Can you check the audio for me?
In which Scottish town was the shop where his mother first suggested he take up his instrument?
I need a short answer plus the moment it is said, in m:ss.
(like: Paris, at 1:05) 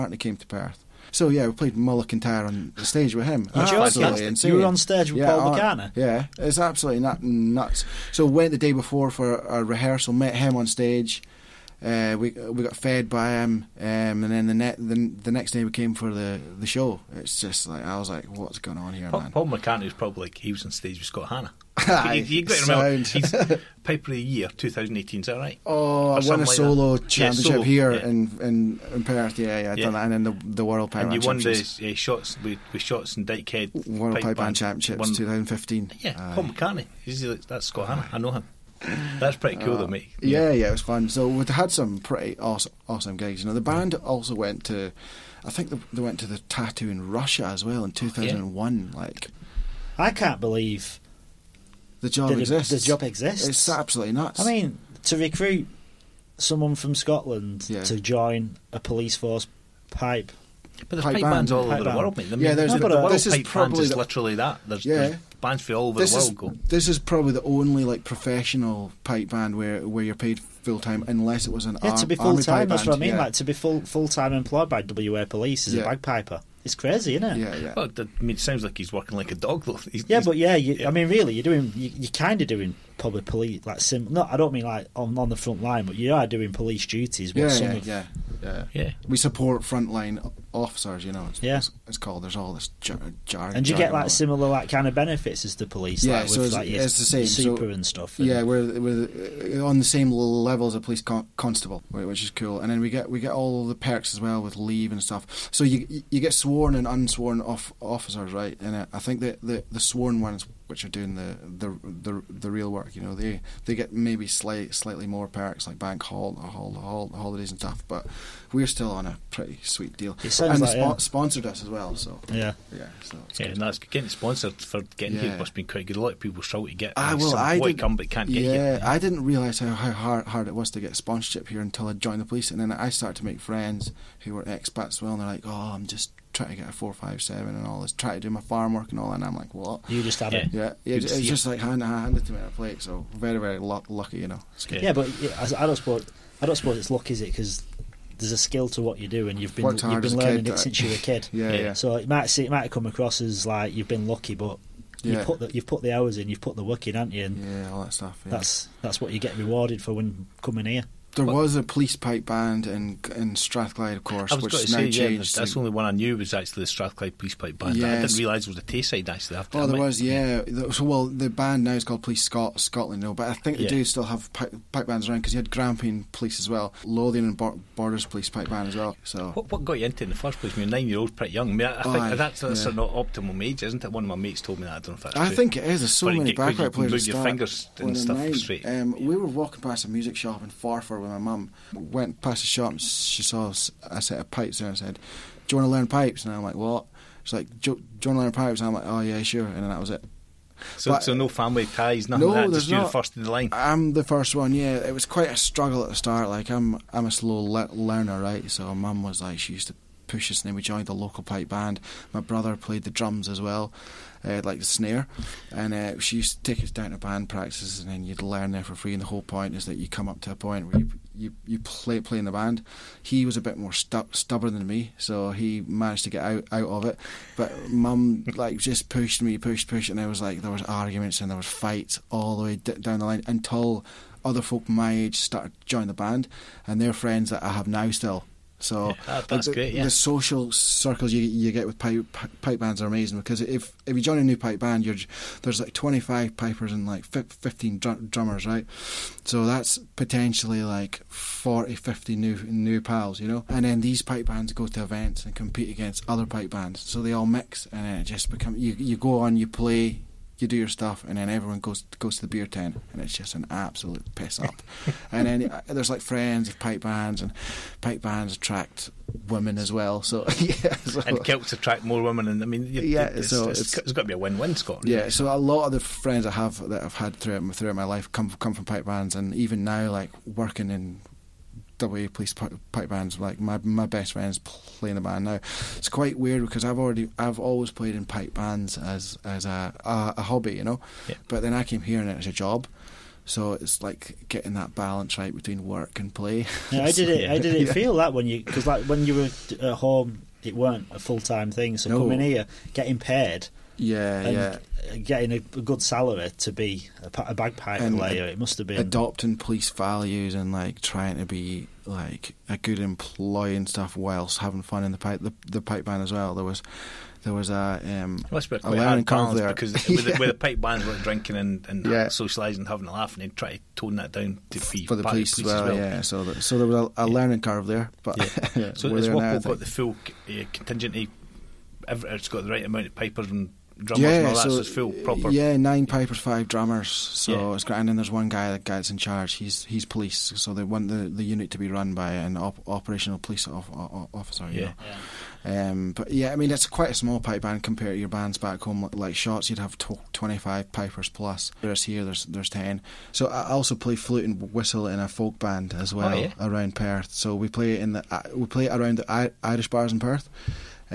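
Forfar, at 3:10.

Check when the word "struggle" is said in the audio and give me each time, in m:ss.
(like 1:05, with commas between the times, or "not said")
2:06, 3:25.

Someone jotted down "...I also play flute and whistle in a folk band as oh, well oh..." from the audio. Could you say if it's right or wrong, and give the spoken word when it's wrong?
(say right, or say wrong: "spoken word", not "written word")
right.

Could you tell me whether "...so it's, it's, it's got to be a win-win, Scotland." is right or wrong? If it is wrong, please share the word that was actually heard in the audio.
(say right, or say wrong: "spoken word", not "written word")
right.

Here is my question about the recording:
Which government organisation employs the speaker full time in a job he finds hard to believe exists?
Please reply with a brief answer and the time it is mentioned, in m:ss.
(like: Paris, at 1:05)
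WA Police, at 1:14.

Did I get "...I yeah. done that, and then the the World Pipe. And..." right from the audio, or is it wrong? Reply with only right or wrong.
right.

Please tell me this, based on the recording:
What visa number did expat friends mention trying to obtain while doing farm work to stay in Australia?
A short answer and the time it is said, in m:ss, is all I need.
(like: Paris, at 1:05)
457, at 2:16.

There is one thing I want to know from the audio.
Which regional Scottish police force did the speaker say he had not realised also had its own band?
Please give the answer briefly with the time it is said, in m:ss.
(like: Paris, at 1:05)
Tayside, at 2:48.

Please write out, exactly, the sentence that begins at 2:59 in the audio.
So what, what got you into in the first place?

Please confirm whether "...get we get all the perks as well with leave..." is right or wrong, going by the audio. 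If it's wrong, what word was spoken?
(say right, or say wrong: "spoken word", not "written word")
right.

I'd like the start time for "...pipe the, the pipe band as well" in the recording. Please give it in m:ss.
5:14.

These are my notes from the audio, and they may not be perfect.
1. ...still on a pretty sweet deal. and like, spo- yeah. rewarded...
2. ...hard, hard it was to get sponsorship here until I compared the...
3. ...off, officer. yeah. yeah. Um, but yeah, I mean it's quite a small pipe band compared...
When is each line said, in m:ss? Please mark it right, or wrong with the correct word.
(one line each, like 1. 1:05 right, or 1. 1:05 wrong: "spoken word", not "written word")
1. 1:58 wrong: "sponsored", not "rewarded"
2. 2:09 wrong: "joined", not "compared"
3. 5:43 right.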